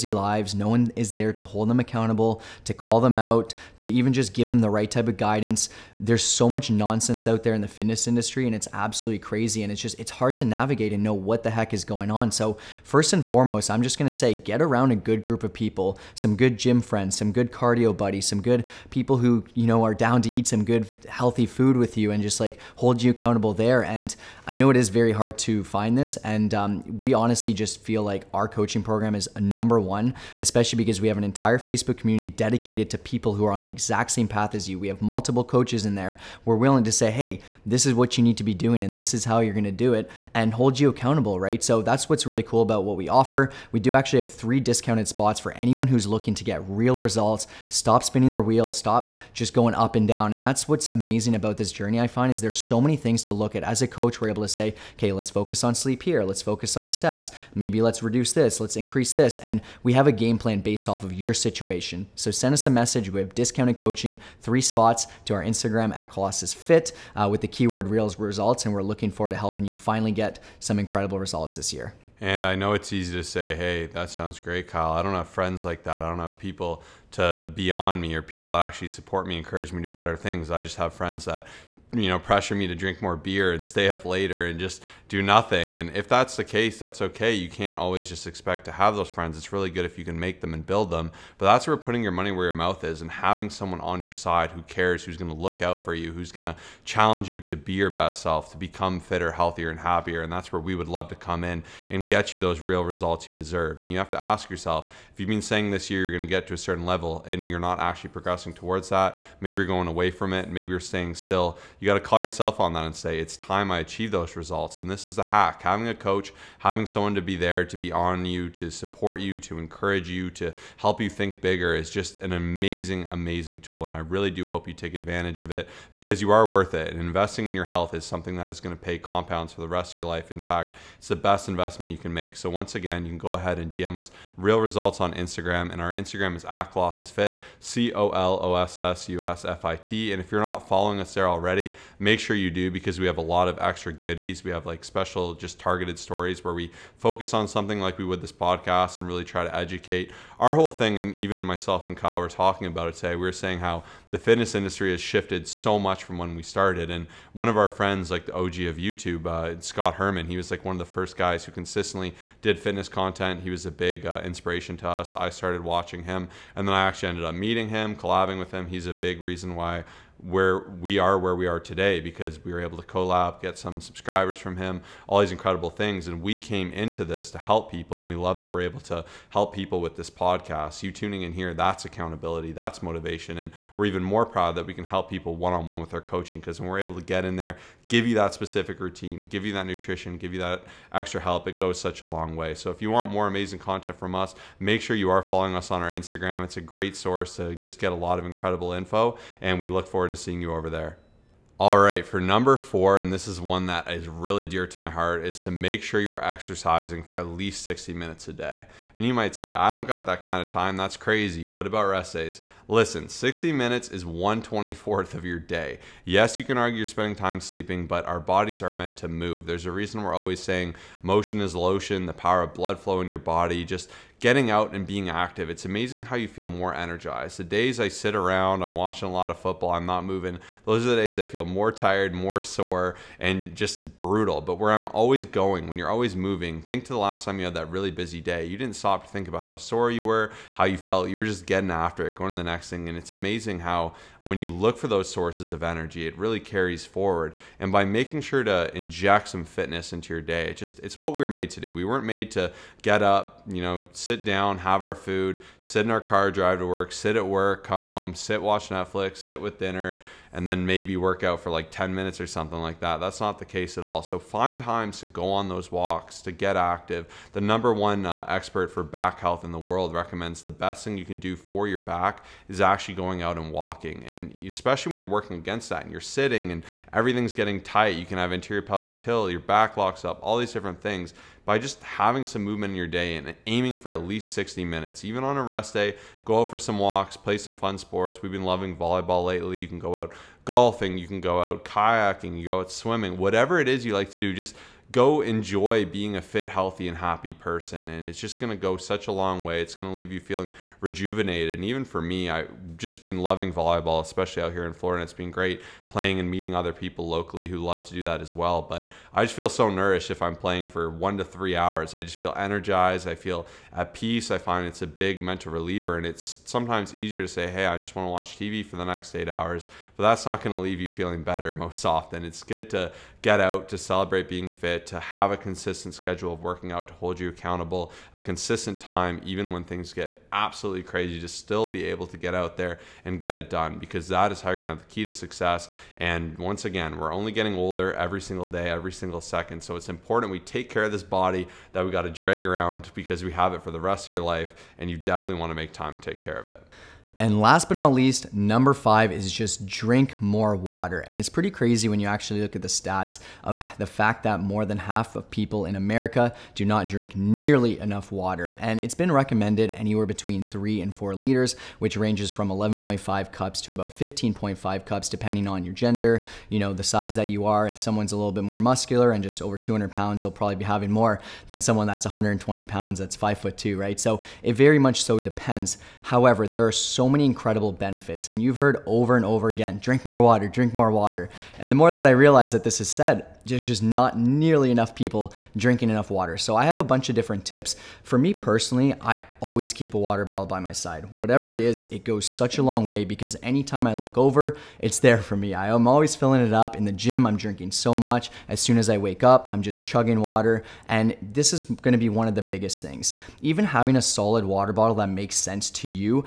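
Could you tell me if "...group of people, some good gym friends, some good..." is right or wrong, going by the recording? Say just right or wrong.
right.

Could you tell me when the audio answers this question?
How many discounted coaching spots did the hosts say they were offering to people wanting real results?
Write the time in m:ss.
0:44.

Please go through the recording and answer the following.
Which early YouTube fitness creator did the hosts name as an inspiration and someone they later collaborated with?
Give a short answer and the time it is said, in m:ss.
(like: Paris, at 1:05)
Scott Herman, at 2:39.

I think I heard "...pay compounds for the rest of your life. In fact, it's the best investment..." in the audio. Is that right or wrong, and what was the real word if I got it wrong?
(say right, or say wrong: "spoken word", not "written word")
right.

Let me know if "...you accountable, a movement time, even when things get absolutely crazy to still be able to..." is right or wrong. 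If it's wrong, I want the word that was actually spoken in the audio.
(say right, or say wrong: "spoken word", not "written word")
wrong: "consistent", not "movement".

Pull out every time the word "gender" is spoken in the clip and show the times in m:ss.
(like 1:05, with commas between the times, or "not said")
6:05.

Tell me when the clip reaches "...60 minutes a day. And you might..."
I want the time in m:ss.
3:27.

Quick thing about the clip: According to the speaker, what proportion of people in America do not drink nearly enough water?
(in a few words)
more than half.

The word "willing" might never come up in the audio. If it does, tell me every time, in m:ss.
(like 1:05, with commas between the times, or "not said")
0:36.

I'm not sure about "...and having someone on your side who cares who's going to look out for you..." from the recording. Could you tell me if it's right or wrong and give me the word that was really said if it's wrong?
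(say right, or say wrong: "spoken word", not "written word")
right.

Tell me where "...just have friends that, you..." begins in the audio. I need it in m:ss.
1:20.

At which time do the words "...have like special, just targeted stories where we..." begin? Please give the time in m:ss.
2:24.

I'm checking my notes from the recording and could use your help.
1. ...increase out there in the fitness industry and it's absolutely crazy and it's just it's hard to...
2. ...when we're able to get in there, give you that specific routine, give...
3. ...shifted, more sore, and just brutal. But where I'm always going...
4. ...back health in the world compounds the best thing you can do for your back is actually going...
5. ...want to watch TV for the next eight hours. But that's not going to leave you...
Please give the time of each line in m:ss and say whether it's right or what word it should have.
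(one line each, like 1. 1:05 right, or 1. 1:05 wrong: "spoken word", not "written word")
1. 0:06 wrong: "nonsense", not "increase"
2. 3:06 right
3. 3:51 wrong: "tired", not "shifted"
4. 4:28 wrong: "recommends", not "compounds"
5. 5:17 right.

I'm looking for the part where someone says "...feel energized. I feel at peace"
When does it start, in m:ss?
5:12.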